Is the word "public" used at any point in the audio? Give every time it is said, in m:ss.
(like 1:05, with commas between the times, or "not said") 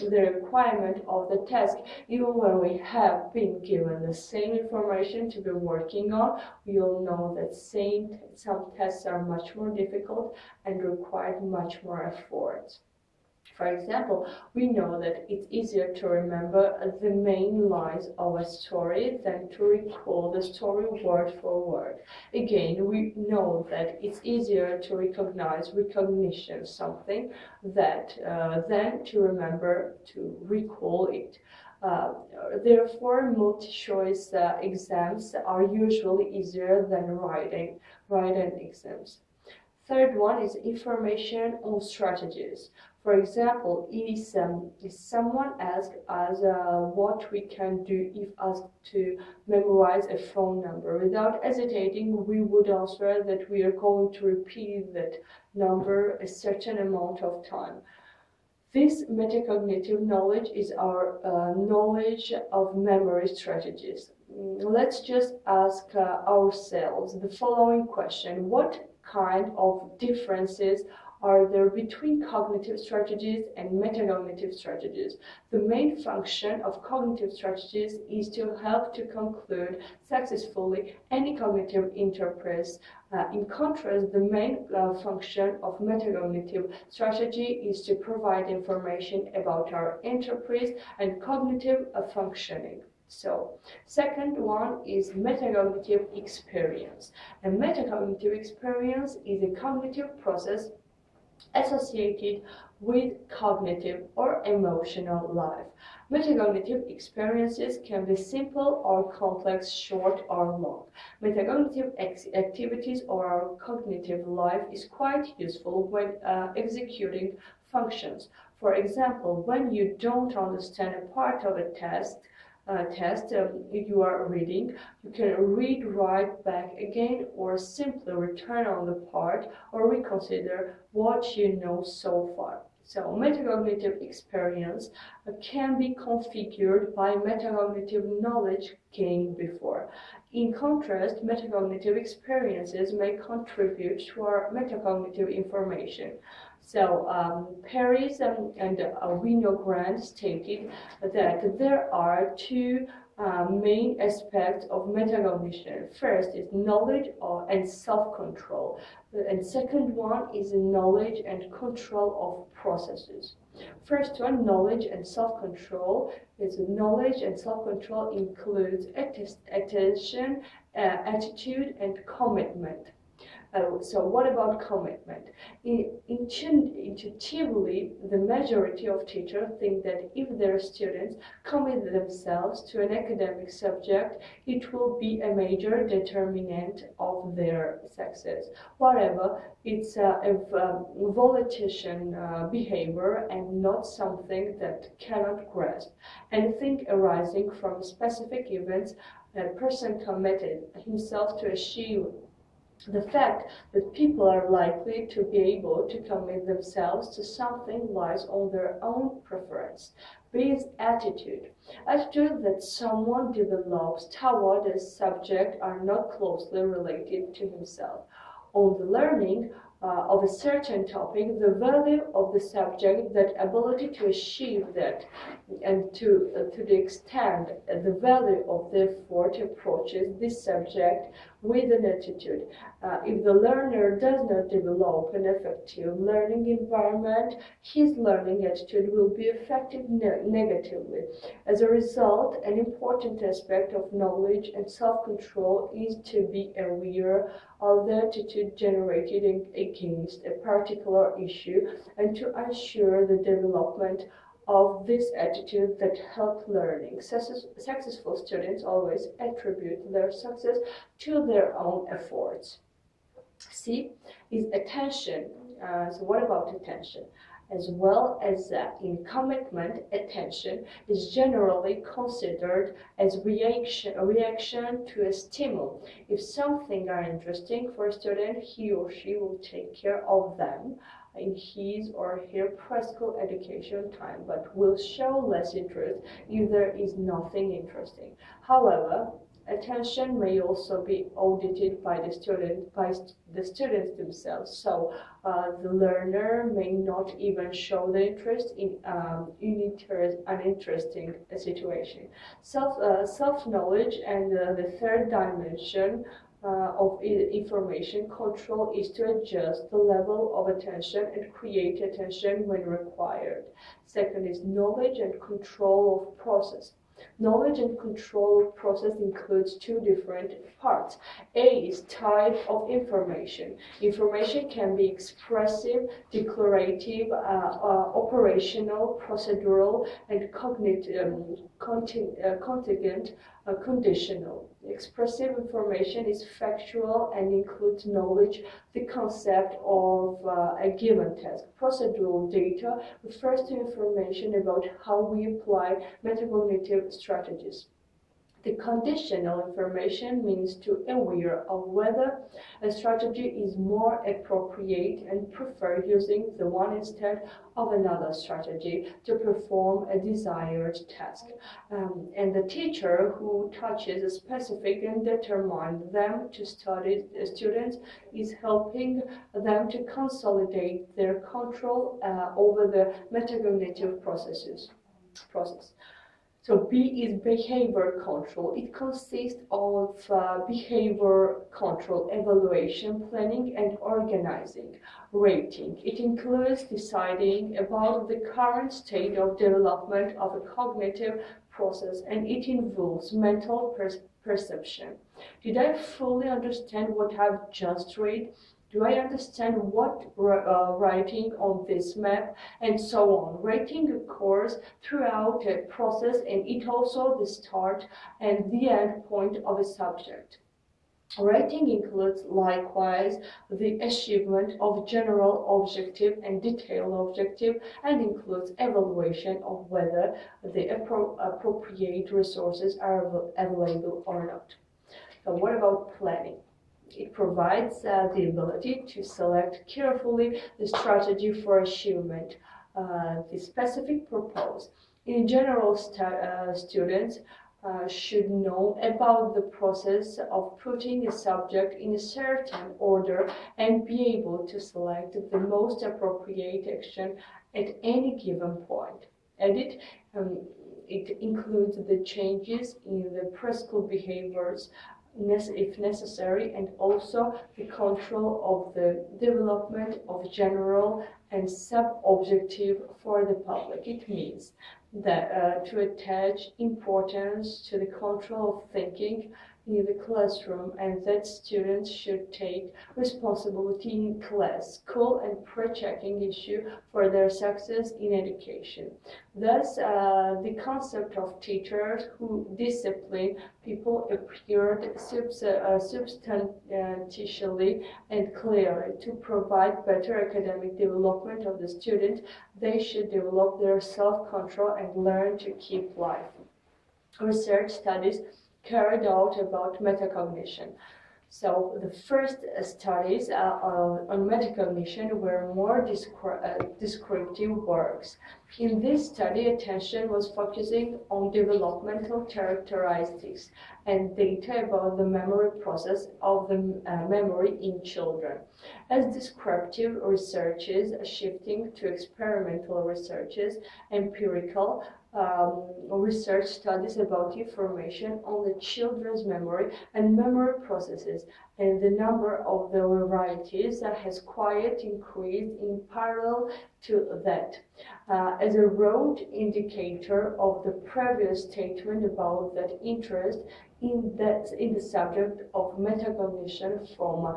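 7:43.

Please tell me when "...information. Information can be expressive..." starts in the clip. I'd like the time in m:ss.
5:22.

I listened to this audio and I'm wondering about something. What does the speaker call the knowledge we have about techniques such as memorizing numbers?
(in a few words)
Knowledge of memory strategies.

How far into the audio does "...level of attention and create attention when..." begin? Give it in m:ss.
5:09.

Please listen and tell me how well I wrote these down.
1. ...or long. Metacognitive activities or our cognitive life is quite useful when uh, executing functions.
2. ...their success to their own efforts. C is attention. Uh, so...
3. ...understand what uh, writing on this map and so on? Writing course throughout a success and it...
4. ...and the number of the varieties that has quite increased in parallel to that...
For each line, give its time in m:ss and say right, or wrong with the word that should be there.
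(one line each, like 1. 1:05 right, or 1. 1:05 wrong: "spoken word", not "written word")
1. 1:50 right
2. 4:19 right
3. 6:38 wrong: "process", not "success"
4. 8:51 right.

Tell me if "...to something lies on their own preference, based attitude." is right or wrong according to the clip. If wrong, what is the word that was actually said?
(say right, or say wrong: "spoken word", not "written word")
right.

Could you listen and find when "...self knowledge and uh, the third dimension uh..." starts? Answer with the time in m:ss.
5:03.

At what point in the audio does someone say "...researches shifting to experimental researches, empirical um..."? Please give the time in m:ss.
8:40.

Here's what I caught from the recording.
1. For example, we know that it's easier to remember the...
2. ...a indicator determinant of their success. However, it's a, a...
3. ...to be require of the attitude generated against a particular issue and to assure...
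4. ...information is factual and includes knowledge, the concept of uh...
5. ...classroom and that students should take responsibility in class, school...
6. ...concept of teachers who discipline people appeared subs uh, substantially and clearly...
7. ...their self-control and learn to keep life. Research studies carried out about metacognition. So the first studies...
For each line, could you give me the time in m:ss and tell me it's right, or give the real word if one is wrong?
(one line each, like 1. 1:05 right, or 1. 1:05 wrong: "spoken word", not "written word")
1. 0:13 right
2. 3:05 wrong: "major", not "indicator"
3. 4:06 wrong: "aware", not "require"
4. 5:35 right
5. 7:50 right
6. 8:00 right
7. 8:13 right.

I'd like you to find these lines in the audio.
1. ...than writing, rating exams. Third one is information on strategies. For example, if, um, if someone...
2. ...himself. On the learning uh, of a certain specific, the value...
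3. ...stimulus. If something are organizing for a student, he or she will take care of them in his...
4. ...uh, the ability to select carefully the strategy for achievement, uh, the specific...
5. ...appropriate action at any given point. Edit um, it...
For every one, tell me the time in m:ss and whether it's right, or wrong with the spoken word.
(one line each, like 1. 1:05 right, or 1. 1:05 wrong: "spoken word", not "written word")
1. 0:36 wrong: "writing", not "rating"
2. 3:37 wrong: "topic", not "specific"
3. 4:35 wrong: "interesting", not "organizing"
4. 7:07 right
5. 7:25 right.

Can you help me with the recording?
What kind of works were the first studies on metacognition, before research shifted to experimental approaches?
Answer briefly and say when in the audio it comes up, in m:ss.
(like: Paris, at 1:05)
Descriptive works, at 8:26.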